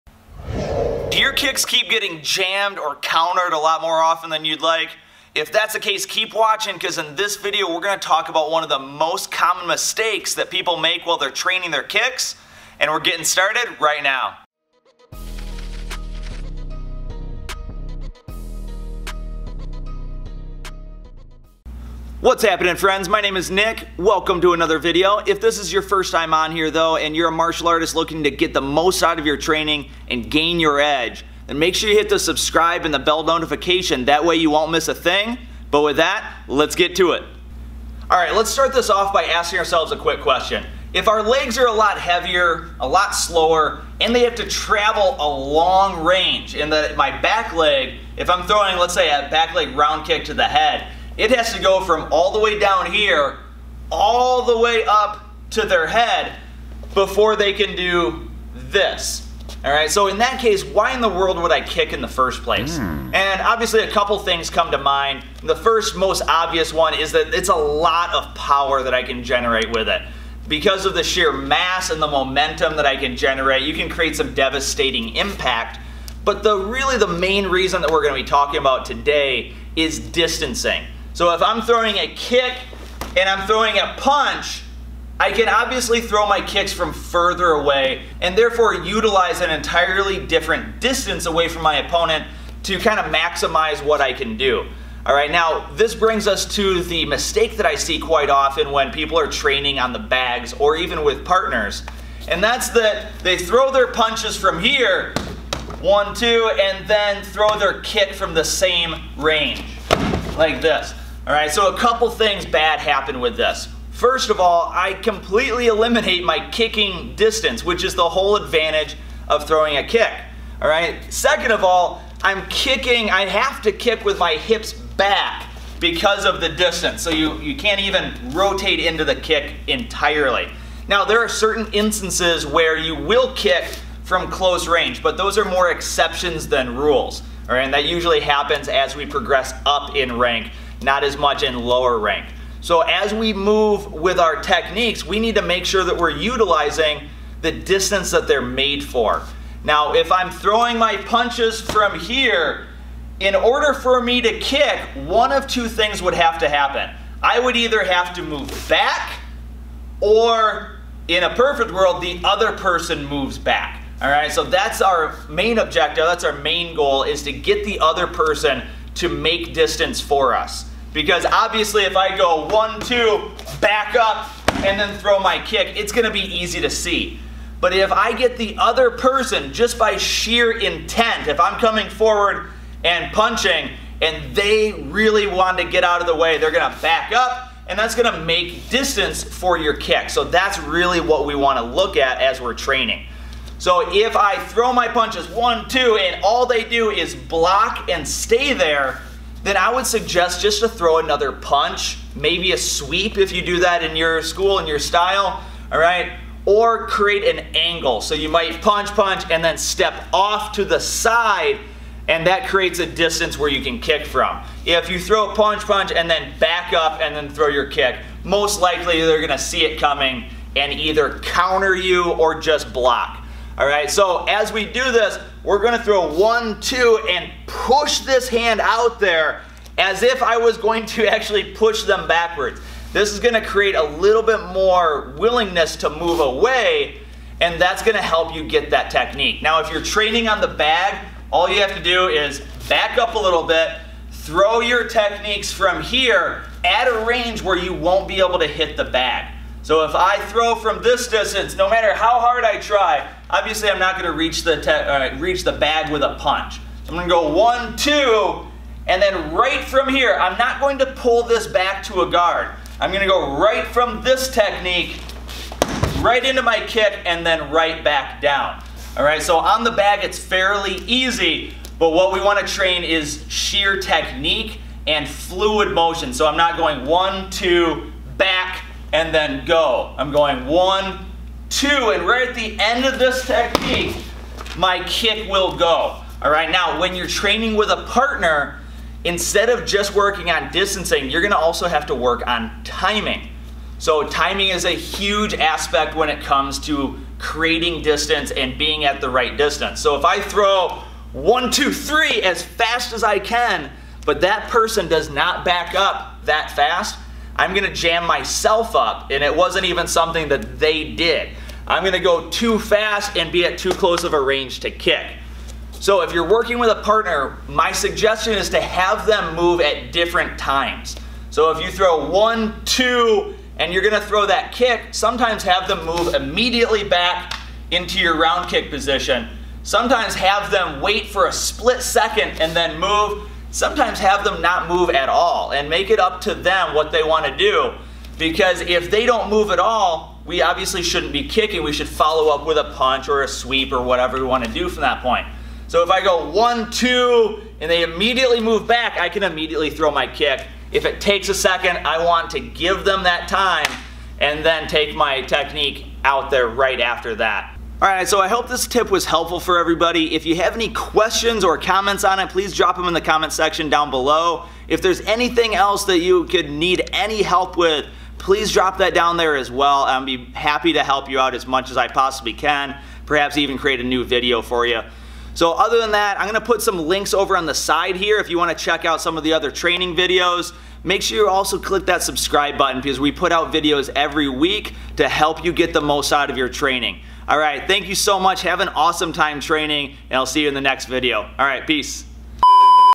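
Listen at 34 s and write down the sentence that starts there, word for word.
That way you won't miss a thing.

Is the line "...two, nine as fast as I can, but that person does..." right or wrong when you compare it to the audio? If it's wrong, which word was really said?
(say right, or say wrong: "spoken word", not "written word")
wrong: "three", not "nine".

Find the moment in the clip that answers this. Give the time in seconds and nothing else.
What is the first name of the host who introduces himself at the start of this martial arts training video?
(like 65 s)
23 s.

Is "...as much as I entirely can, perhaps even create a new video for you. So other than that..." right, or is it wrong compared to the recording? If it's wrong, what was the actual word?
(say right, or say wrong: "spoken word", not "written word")
wrong: "possibly", not "entirely".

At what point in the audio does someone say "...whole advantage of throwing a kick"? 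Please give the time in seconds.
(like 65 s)
118 s.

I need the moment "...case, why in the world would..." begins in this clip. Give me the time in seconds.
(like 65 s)
60 s.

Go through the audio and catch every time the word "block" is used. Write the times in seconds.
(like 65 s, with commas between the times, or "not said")
197 s, 222 s.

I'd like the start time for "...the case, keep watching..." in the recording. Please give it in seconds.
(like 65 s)
5 s.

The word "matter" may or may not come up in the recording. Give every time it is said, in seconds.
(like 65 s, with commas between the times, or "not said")
251 s.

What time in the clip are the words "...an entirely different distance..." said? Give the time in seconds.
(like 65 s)
89 s.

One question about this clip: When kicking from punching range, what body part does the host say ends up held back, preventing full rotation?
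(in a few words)
Hips.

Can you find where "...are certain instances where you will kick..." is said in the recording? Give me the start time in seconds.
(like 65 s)
131 s.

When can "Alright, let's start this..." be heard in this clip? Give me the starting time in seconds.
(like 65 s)
38 s.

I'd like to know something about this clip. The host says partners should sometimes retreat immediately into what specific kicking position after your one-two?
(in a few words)
Round kick position.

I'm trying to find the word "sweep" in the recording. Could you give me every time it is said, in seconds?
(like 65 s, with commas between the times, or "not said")
202 s, 343 s.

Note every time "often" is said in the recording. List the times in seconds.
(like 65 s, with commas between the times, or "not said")
4 s, 98 s.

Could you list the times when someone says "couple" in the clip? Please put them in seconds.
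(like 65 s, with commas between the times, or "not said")
63 s, 111 s.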